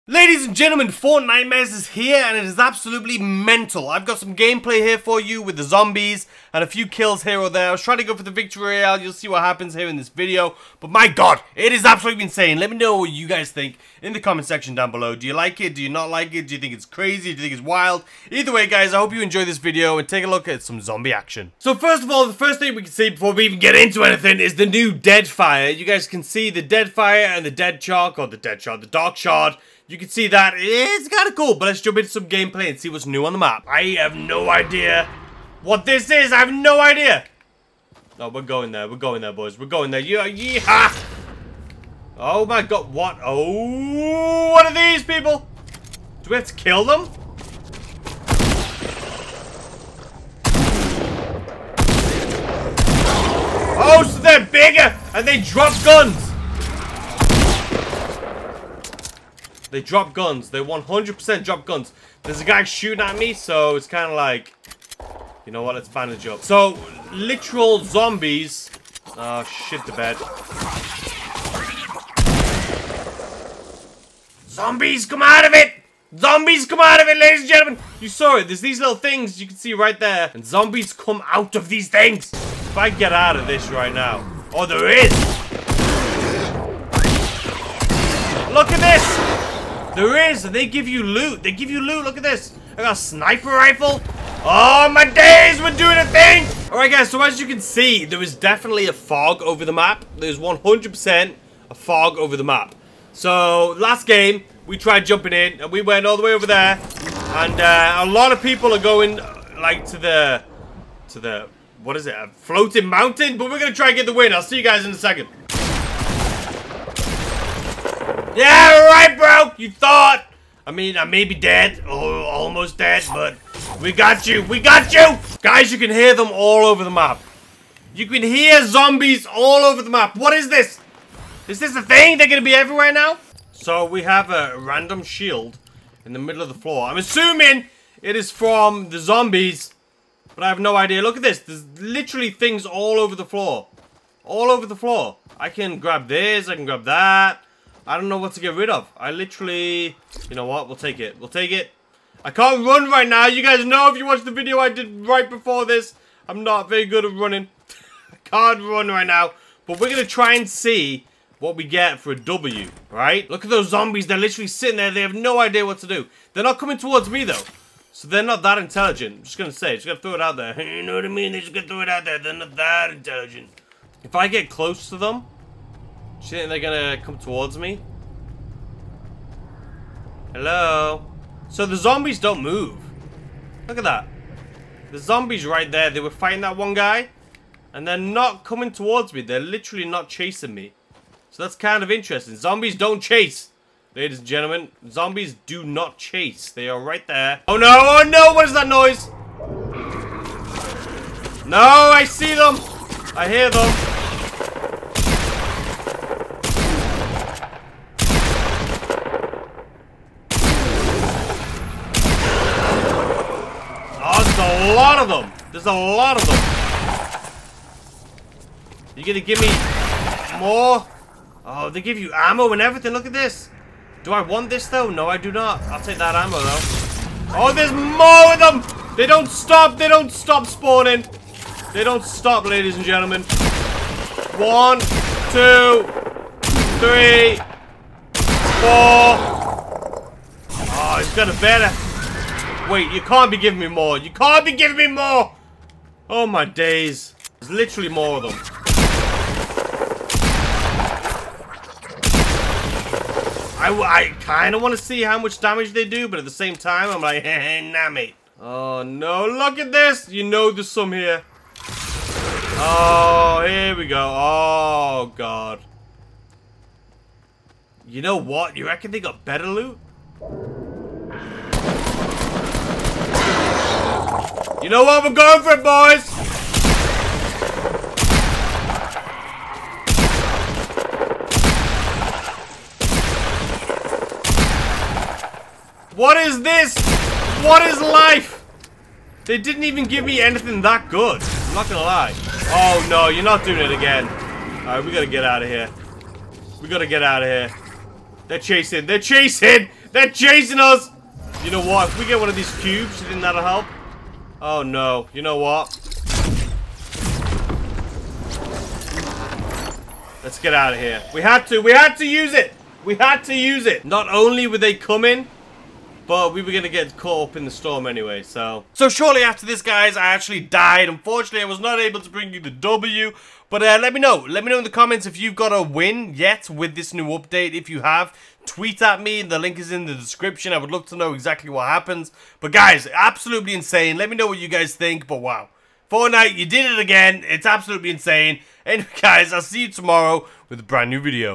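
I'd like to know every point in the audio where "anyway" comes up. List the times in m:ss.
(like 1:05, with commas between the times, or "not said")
5:17, 5:38.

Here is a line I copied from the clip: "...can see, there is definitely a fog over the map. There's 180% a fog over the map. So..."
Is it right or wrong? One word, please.
wrong.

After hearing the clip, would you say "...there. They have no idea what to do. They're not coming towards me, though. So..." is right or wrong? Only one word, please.
right.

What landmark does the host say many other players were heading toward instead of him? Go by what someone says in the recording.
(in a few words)
A floating mountain.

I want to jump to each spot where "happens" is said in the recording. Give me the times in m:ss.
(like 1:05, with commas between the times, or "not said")
0:09, 5:31.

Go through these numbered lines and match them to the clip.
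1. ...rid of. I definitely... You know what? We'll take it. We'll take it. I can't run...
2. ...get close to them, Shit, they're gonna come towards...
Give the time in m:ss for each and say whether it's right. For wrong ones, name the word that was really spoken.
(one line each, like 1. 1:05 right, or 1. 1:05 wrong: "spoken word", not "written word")
1. 2:28 wrong: "literally", not "definitely"
2. 2:54 right.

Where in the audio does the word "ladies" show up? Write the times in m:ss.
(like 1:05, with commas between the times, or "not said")
0:00, 1:17, 3:13, 3:52.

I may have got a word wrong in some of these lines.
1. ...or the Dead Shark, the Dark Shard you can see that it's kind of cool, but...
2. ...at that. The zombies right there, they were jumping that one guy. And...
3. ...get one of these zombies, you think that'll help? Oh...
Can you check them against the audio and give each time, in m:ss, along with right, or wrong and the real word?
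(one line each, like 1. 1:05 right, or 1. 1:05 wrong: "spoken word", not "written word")
1. 0:28 right
2. 3:03 wrong: "fighting", not "jumping"
3. 5:02 wrong: "cubes", not "zombies".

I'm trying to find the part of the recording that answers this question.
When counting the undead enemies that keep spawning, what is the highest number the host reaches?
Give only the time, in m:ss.
3:58.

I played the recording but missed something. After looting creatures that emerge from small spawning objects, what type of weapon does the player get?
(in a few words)
Sniper rifle.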